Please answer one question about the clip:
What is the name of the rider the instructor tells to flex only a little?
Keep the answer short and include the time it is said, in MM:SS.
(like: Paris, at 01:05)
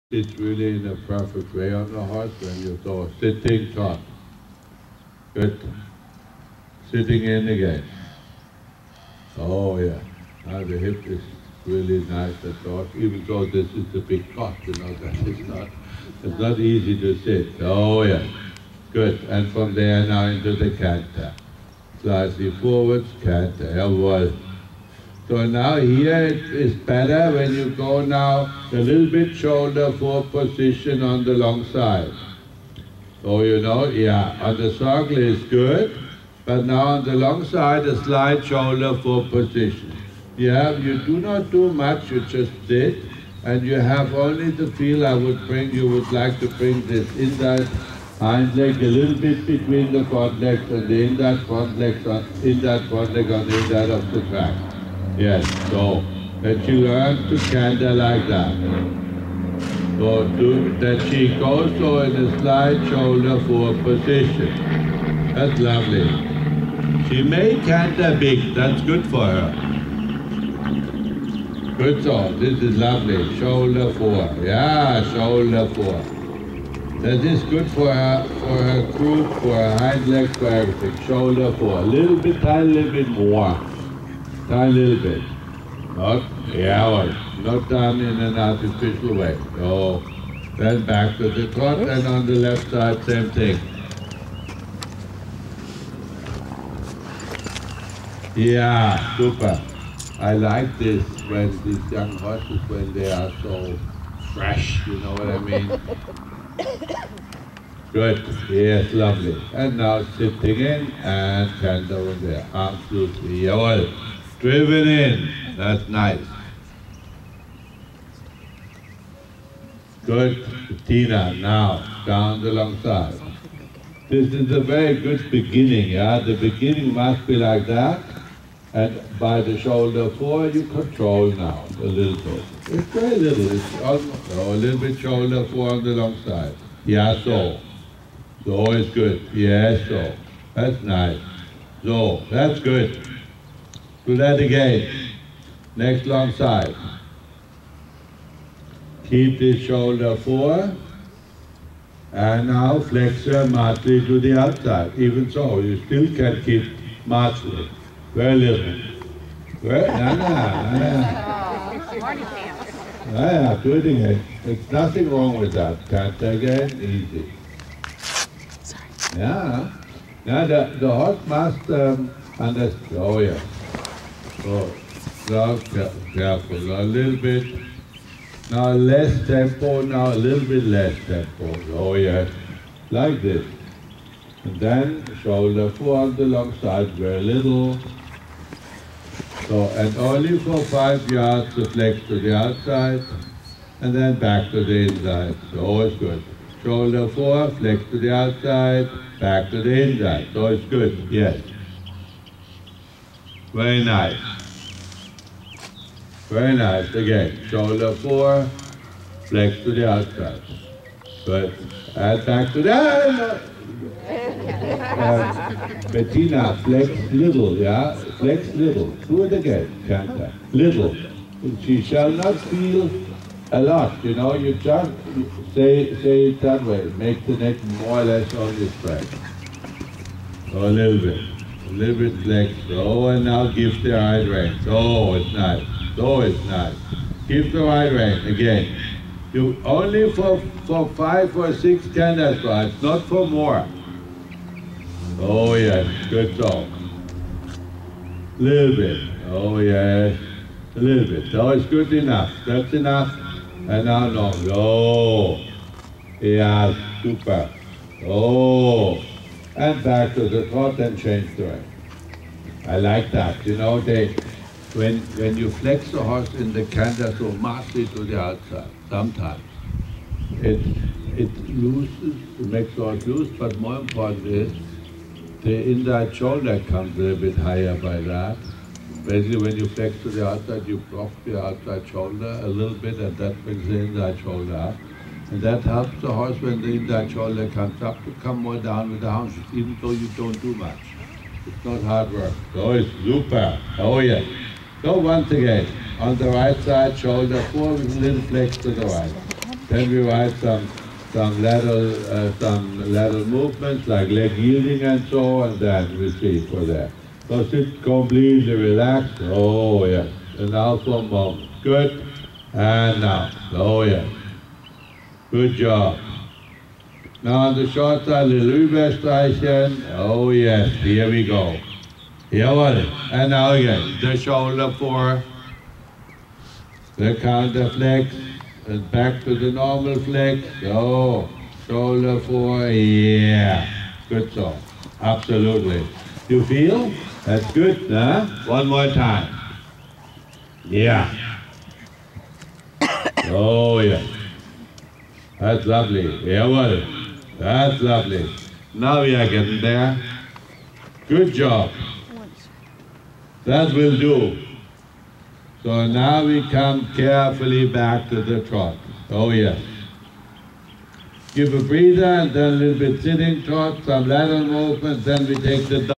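Bettina, at 03:35.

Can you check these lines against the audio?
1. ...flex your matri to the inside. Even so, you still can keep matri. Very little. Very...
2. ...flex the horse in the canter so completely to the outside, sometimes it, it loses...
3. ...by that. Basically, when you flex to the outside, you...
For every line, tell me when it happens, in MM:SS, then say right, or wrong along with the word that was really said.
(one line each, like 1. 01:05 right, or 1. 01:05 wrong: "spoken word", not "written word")
1. 02:32 wrong: "outside", not "inside"
2. 04:25 wrong: "massively", not "completely"
3. 04:37 right.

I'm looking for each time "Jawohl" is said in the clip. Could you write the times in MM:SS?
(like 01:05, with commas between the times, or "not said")
00:23.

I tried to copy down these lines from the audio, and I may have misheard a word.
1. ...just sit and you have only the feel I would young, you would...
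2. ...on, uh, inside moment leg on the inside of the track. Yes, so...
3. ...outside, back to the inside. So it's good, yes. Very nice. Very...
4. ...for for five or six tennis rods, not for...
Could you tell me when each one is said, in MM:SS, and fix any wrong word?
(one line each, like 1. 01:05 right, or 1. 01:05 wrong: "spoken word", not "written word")
1. 00:42 wrong: "bring", not "young"
2. 00:52 wrong: "front", not "moment"
3. 03:18 right
4. 04:00 right.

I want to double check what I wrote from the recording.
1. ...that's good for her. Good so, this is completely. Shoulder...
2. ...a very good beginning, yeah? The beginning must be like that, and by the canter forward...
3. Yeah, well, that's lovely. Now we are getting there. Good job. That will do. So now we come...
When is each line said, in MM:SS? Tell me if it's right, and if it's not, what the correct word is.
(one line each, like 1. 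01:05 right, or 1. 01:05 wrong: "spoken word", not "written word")
1. 01:08 wrong: "lovely", not "completely"
2. 02:04 wrong: "shoulder", not "canter"
3. 05:46 right.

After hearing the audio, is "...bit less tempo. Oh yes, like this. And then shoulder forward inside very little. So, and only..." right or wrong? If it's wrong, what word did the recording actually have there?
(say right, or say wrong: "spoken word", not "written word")
wrong: "alongside", not "inside".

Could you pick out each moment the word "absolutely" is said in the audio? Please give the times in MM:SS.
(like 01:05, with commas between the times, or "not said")
01:52, 05:34.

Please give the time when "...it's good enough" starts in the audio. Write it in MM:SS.
04:11.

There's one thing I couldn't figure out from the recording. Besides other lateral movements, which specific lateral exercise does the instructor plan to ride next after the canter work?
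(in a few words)
Leg yielding.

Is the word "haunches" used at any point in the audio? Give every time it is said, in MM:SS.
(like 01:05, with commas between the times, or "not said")
04:49.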